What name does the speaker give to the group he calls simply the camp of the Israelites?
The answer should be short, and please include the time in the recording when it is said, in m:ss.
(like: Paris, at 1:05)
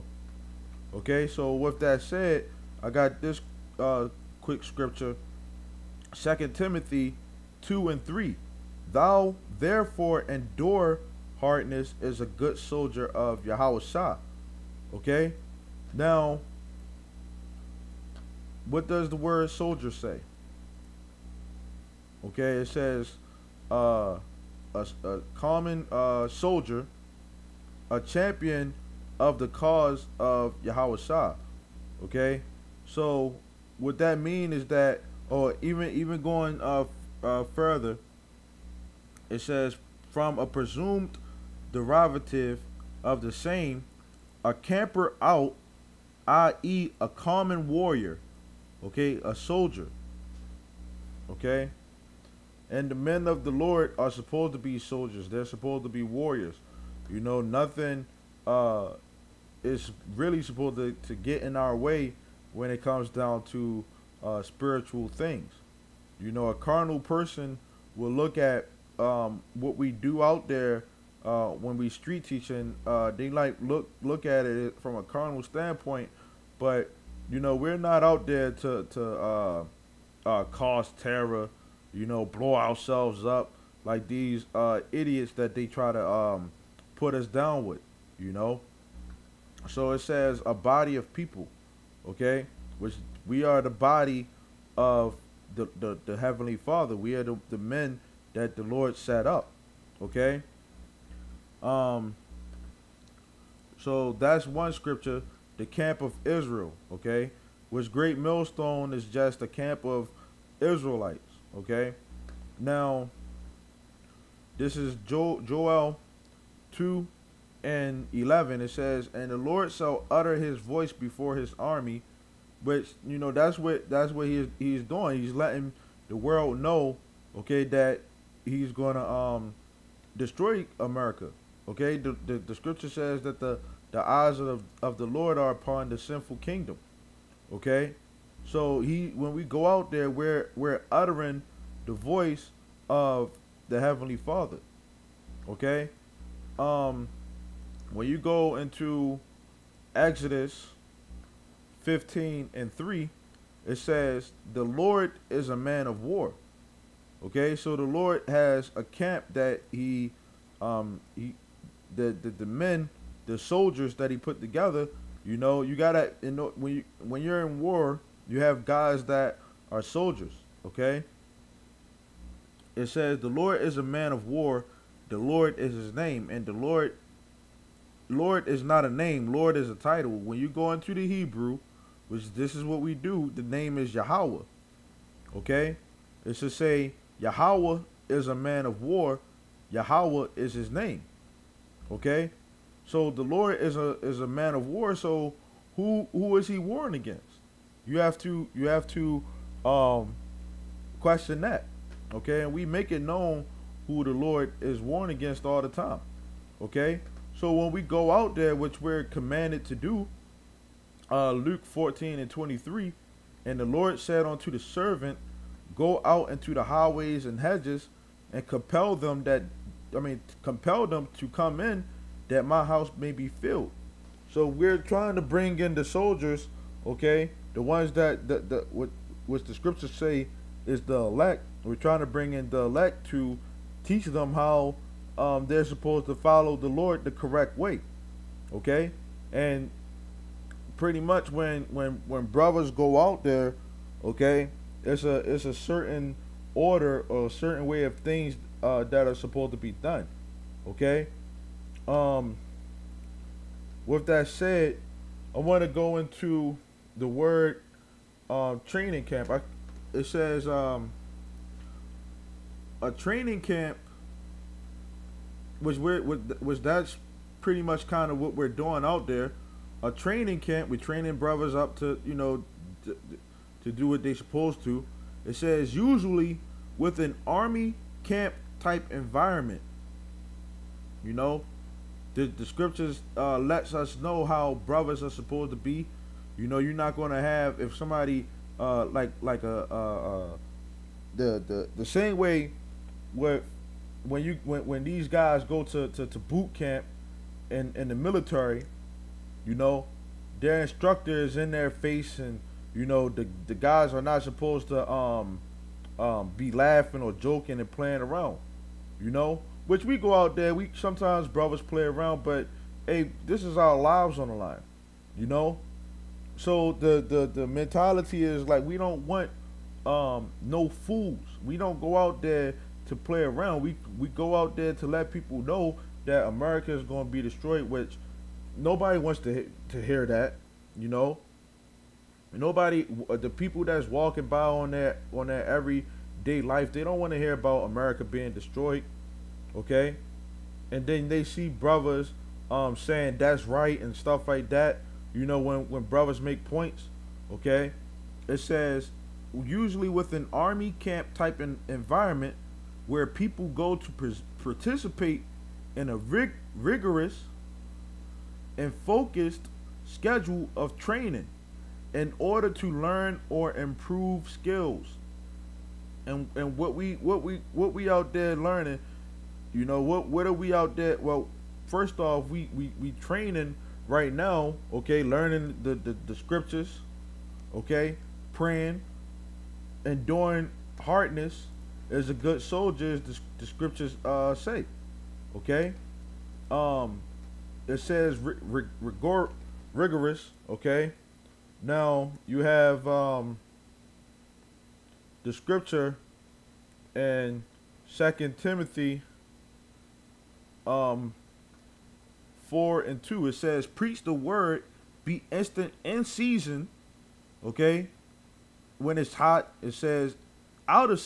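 Great Millstone, at 1:47.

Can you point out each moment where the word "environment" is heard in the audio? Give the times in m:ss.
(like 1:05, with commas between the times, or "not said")
4:38, 5:51.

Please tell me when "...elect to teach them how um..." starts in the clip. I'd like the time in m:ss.
3:52.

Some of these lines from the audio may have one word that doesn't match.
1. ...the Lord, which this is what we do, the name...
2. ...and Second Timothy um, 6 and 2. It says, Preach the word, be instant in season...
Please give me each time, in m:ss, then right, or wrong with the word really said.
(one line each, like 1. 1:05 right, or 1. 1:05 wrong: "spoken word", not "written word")
1. 3:00 wrong: "Hebrew", not "Lord"
2. 6:36 wrong: "4", not "6".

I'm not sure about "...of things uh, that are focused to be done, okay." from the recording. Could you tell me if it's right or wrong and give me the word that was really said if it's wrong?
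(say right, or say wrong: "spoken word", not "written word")
wrong: "supposed", not "focused".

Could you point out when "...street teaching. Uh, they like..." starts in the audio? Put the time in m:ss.
1:11.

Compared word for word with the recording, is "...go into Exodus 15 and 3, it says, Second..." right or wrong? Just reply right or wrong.
wrong.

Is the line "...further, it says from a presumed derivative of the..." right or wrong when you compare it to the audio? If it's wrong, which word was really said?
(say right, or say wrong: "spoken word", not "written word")
right.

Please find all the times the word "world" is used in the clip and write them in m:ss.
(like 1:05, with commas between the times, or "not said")
2:06.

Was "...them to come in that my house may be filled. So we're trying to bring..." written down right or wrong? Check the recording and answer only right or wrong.
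right.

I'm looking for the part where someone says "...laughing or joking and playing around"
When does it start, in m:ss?
5:06.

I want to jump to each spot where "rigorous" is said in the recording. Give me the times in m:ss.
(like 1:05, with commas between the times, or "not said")
5:56, 6:29.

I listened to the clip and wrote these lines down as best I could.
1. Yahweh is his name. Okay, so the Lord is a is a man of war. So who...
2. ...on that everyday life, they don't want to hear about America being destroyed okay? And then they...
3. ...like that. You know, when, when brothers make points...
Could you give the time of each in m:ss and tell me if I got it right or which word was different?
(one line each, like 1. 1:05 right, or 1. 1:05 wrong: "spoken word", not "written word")
1. 3:09 right
2. 5:35 right
3. 5:44 right.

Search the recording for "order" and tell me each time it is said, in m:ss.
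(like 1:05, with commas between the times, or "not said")
4:06, 6:02.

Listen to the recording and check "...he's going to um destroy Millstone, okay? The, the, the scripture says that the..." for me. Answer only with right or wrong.
wrong.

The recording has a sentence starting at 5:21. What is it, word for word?
We don't go out there to play around.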